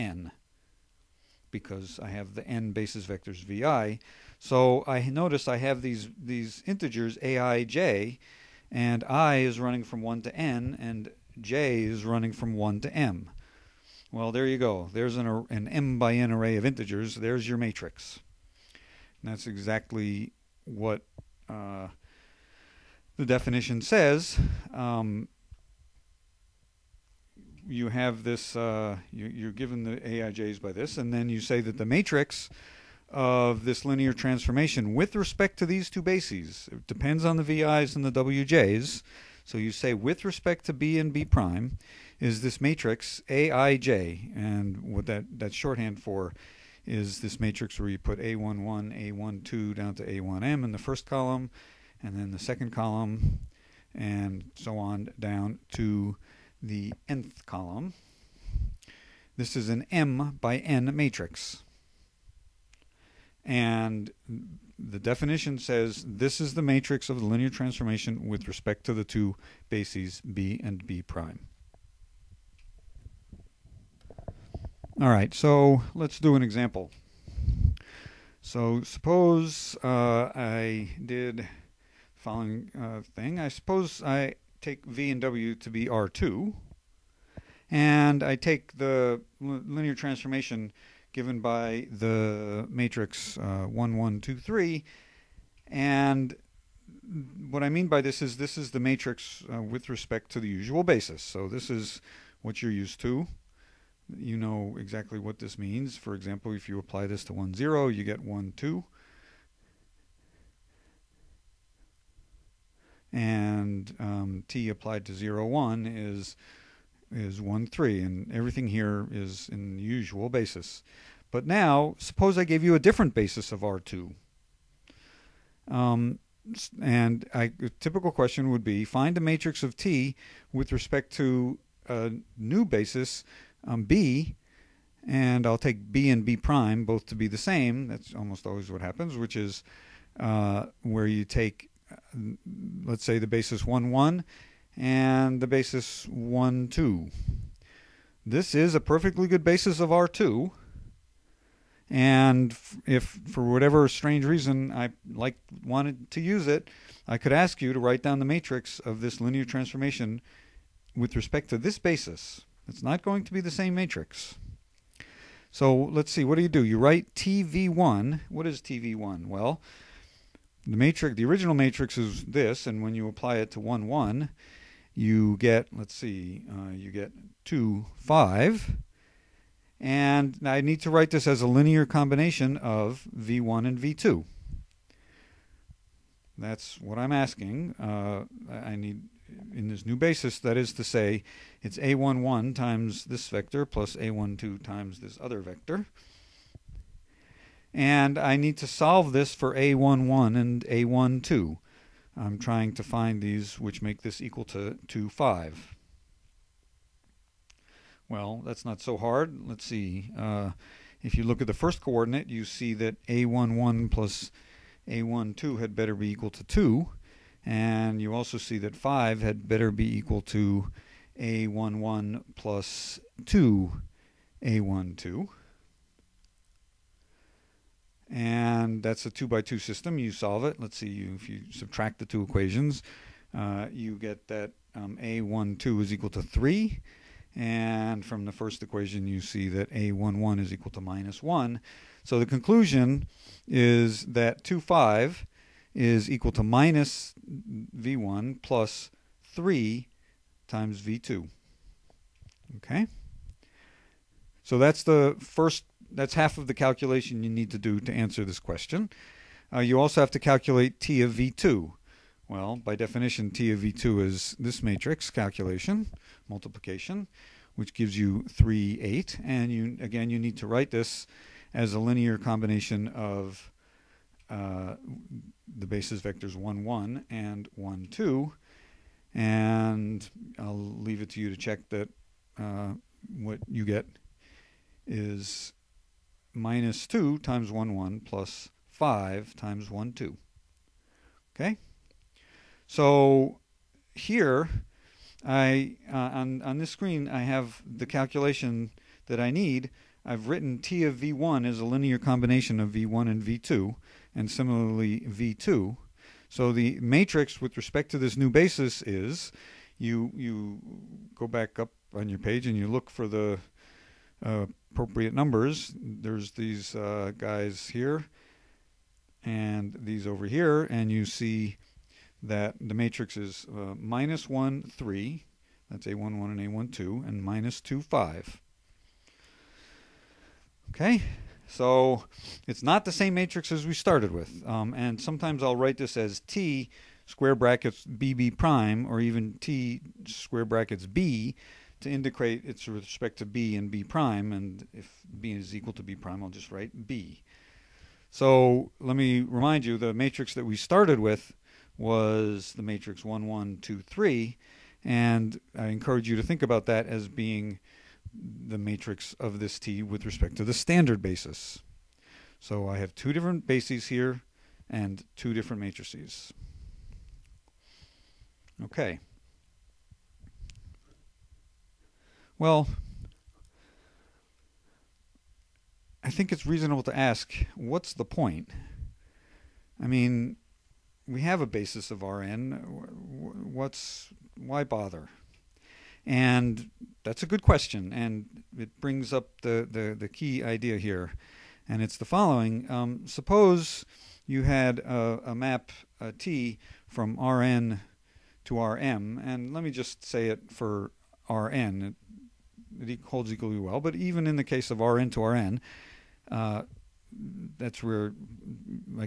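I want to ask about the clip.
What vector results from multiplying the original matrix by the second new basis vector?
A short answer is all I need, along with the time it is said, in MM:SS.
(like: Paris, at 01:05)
3, 8, at 04:28.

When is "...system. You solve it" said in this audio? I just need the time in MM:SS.
03:49.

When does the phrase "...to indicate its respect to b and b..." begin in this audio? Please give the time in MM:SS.
05:41.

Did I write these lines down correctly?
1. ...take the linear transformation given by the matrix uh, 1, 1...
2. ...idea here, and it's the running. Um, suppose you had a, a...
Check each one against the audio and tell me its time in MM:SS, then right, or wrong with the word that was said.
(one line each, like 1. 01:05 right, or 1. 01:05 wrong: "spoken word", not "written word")
1. 01:28 right
2. 06:30 wrong: "following", not "running".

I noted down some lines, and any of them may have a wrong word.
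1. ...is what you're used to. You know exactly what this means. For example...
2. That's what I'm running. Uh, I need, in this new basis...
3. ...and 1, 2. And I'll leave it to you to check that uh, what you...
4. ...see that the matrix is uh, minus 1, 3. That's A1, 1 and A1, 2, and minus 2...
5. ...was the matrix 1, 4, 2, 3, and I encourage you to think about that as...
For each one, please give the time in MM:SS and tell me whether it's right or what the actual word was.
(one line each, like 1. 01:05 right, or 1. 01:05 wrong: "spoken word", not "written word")
1. 01:41 right
2. 03:06 wrong: "asking", not "running"
3. 04:37 right
4. 05:21 right
5. 05:51 wrong: "1", not "4".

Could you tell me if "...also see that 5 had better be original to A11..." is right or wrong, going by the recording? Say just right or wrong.
wrong.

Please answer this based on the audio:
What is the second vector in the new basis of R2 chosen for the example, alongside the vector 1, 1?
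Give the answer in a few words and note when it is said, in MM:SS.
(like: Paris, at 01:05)
1, 2, at 02:25.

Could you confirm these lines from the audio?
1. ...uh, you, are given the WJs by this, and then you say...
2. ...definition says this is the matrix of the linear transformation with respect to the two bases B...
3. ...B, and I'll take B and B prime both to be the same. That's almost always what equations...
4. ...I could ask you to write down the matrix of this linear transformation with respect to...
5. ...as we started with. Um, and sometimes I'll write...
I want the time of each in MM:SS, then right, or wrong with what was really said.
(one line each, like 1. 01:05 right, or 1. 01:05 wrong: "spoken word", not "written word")
1. 00:28 wrong: "AIJs", not "WJs"
2. 01:04 right
3. 02:13 wrong: "happens", not "equations"
4. 02:37 right
5. 05:33 right.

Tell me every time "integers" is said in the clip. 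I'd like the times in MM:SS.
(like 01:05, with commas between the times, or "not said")
00:06, 00:16.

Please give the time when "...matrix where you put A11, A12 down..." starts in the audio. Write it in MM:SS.
00:47.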